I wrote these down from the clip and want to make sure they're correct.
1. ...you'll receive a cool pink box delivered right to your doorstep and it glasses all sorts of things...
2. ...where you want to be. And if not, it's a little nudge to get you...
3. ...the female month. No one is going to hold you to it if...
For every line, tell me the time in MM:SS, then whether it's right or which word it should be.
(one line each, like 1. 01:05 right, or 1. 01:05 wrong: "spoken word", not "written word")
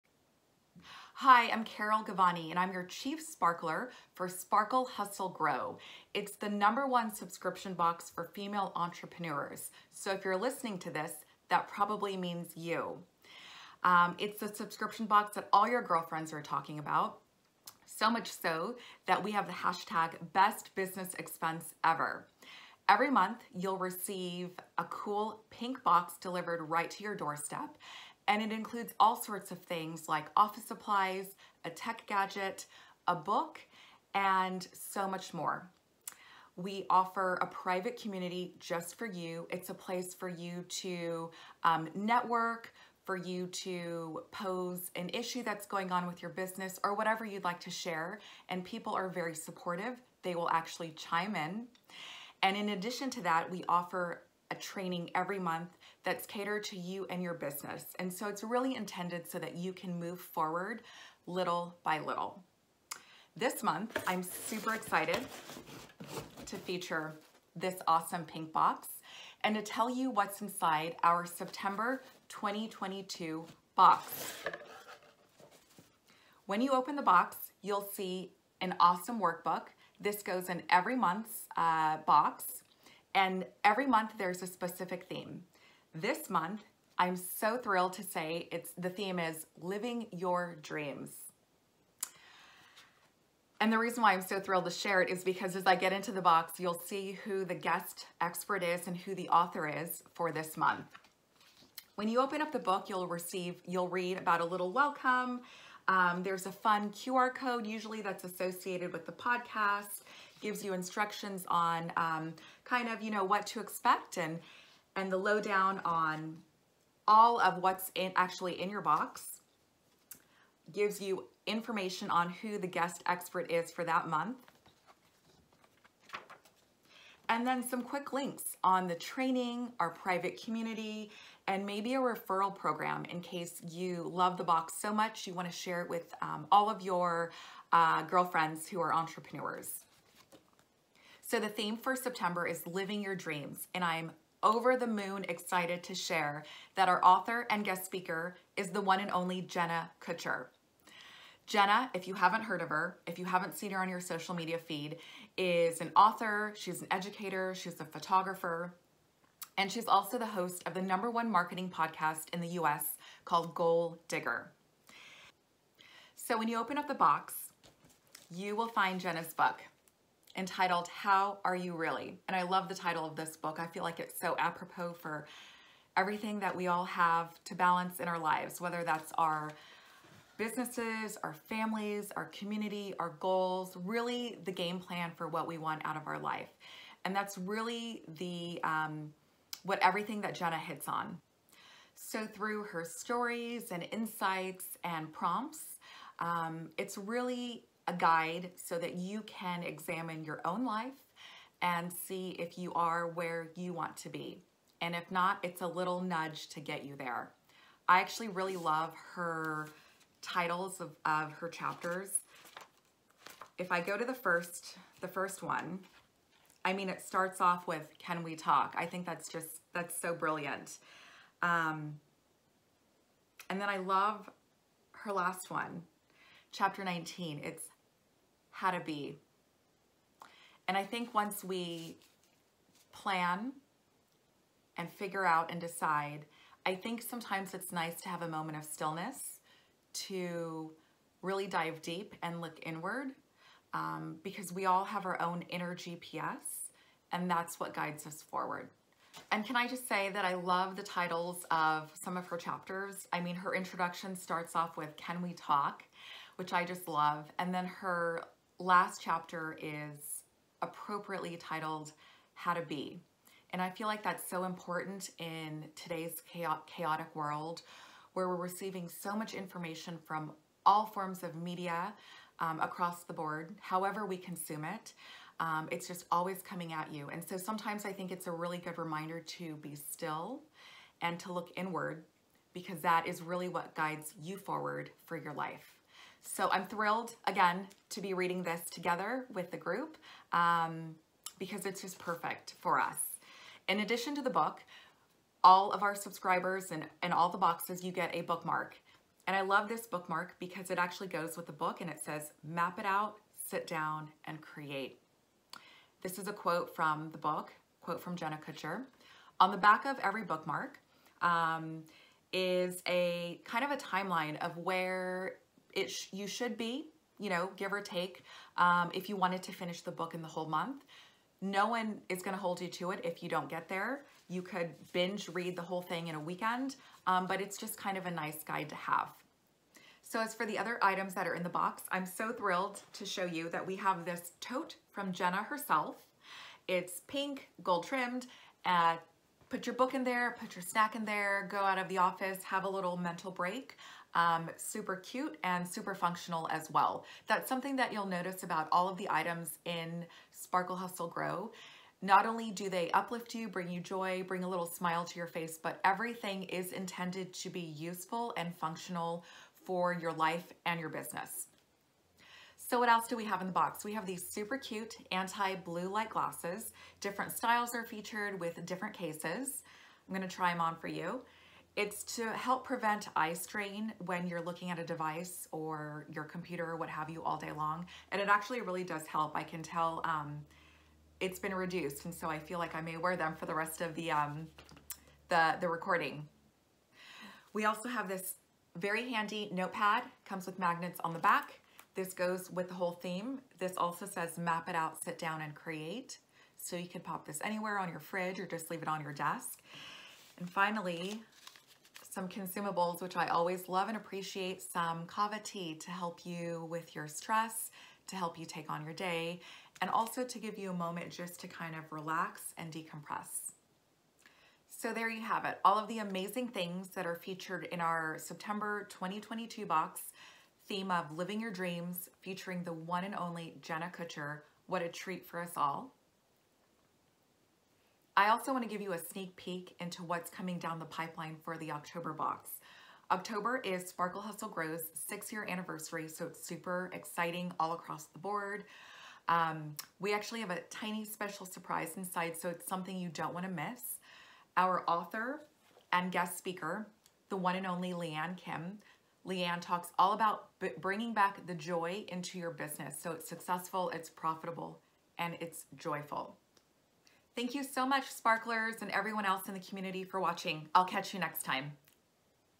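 1. 00:23 wrong: "includes", not "glasses"
2. 03:23 right
3. 05:20 wrong: "whole", not "female".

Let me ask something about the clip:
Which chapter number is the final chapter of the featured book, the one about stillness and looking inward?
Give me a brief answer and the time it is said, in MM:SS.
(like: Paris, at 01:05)
19, at 03:46.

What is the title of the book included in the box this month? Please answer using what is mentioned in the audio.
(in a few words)
How Are You Really?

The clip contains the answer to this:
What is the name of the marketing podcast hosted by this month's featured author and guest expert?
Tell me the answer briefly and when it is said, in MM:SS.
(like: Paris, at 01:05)
Goal Digger, at 02:43.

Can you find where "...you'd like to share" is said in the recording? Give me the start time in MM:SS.
00:47.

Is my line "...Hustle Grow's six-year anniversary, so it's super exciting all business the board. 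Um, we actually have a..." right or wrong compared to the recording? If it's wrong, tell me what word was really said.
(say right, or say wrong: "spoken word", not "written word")
wrong: "across", not "business".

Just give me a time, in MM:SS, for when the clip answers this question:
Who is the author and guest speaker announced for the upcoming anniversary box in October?
07:27.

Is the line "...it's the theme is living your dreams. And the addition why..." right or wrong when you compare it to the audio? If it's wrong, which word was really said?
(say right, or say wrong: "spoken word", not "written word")
wrong: "reason", not "addition".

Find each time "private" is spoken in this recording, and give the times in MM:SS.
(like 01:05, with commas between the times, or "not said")
00:37, 02:09.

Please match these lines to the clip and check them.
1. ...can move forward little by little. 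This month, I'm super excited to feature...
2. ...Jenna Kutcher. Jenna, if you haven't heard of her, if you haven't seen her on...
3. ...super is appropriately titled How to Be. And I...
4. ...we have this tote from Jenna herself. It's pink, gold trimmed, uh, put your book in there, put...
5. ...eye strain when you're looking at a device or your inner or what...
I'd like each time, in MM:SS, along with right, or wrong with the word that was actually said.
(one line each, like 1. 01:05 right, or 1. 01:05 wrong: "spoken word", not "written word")
1. 00:59 right
2. 02:29 right
3. 04:19 wrong: "chapter", not "super"
4. 05:33 right
5. 06:13 wrong: "computer", not "inner".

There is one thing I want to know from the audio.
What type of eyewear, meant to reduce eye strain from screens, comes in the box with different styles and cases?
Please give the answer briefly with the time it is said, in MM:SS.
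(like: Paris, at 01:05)
Anti-blue light glasses, at 06:05.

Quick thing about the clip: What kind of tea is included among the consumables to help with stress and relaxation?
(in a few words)
Kava tea.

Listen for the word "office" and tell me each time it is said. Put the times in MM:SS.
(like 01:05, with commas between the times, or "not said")
00:30, 05:41.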